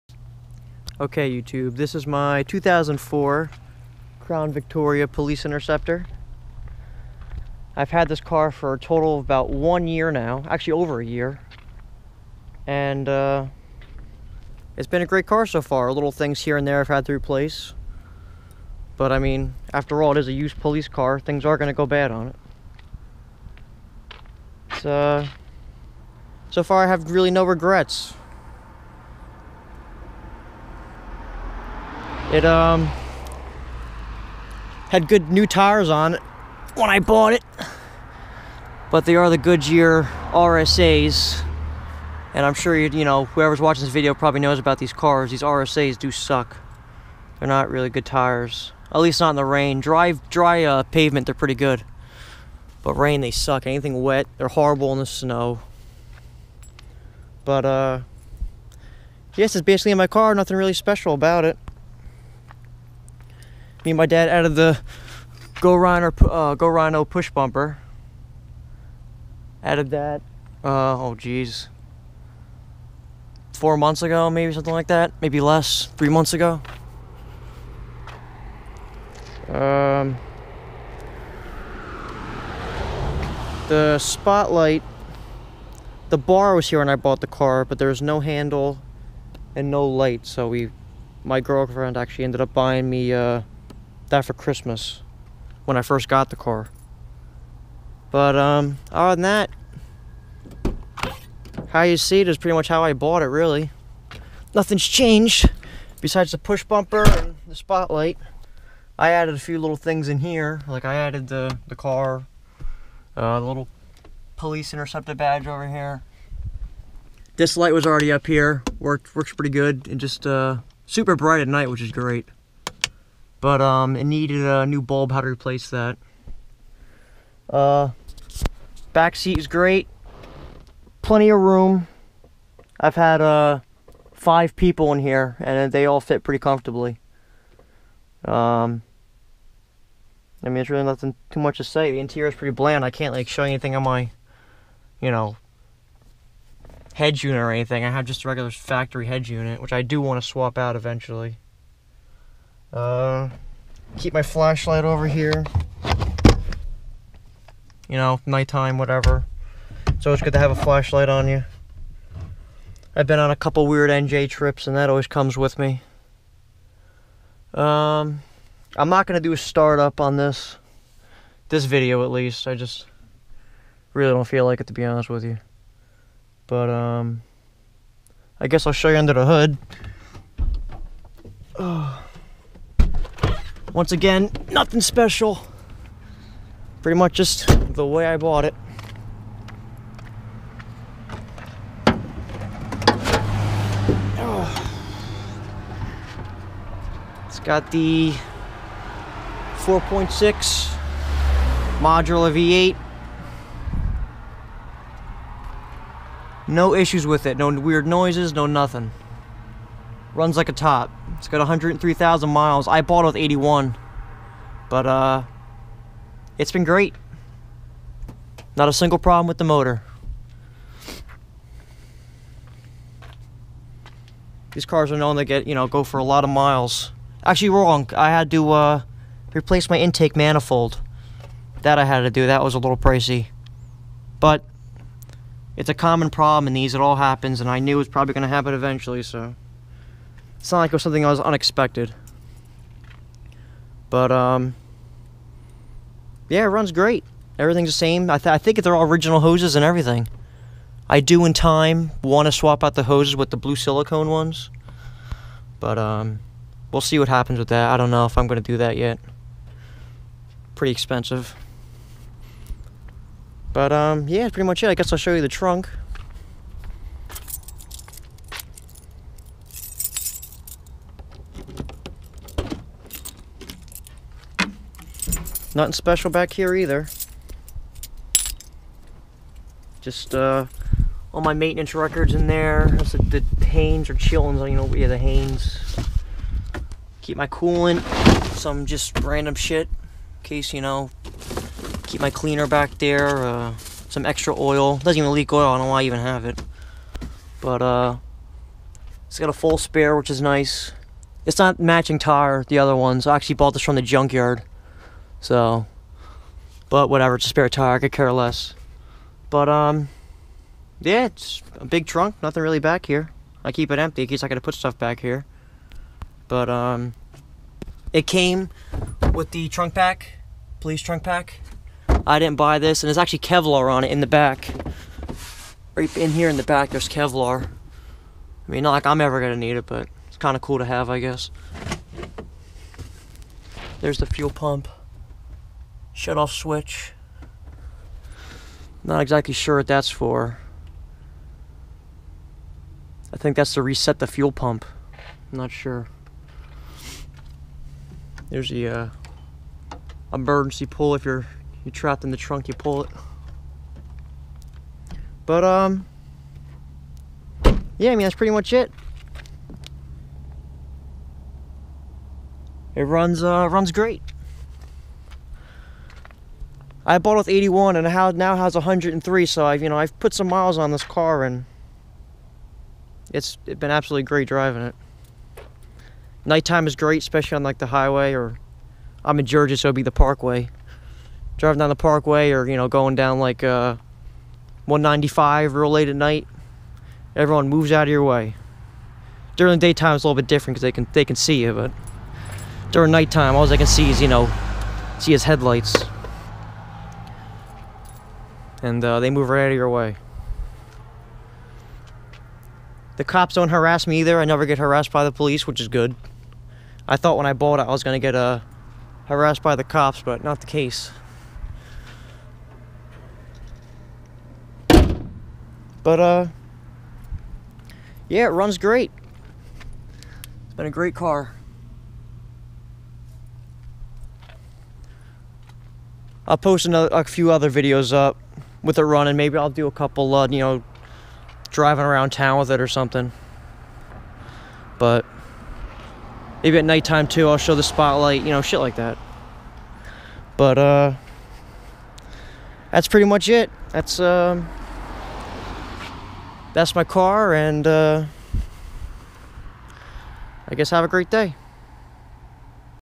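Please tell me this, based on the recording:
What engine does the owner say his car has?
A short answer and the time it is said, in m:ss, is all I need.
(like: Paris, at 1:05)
4.6 modular V8, at 3:19.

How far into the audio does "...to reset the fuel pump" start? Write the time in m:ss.
5:43.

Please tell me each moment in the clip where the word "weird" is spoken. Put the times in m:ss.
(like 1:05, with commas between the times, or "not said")
2:43, 3:27.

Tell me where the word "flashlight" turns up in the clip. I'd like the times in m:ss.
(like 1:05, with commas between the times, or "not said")
2:34, 2:40.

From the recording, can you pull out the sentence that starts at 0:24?
So, so far I have really no regrets.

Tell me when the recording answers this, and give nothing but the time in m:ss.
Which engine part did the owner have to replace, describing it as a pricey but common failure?
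3:49.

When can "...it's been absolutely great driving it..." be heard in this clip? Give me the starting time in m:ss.
6:13.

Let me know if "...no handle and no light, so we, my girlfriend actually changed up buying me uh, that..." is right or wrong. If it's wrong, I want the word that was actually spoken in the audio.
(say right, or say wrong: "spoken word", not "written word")
wrong: "ended", not "changed".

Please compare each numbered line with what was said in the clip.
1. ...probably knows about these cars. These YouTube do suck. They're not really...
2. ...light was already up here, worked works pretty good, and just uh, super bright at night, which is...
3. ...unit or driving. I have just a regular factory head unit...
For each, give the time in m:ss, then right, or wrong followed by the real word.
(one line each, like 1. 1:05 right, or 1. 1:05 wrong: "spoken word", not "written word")
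1. 0:44 wrong: "RSAs", not "YouTube"
2. 1:57 right
3. 2:27 wrong: "anything", not "driving".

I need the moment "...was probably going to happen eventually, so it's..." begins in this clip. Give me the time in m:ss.
3:57.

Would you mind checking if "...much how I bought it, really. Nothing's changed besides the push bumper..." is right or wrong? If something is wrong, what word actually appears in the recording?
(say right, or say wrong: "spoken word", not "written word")
right.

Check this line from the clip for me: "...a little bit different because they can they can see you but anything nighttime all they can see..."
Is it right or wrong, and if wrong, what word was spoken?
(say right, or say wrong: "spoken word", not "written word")
wrong: "during", not "anything".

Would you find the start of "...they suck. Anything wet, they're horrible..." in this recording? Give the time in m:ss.
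0:53.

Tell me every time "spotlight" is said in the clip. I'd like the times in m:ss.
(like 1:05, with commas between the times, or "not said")
1:23, 1:47, 7:17.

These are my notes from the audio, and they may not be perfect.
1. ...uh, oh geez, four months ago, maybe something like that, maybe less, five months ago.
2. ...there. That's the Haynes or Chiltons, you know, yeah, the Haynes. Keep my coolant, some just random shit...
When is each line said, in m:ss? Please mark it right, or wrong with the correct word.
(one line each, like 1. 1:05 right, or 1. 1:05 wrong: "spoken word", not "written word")
1. 1:10 wrong: "three", not "five"
2. 4:42 right.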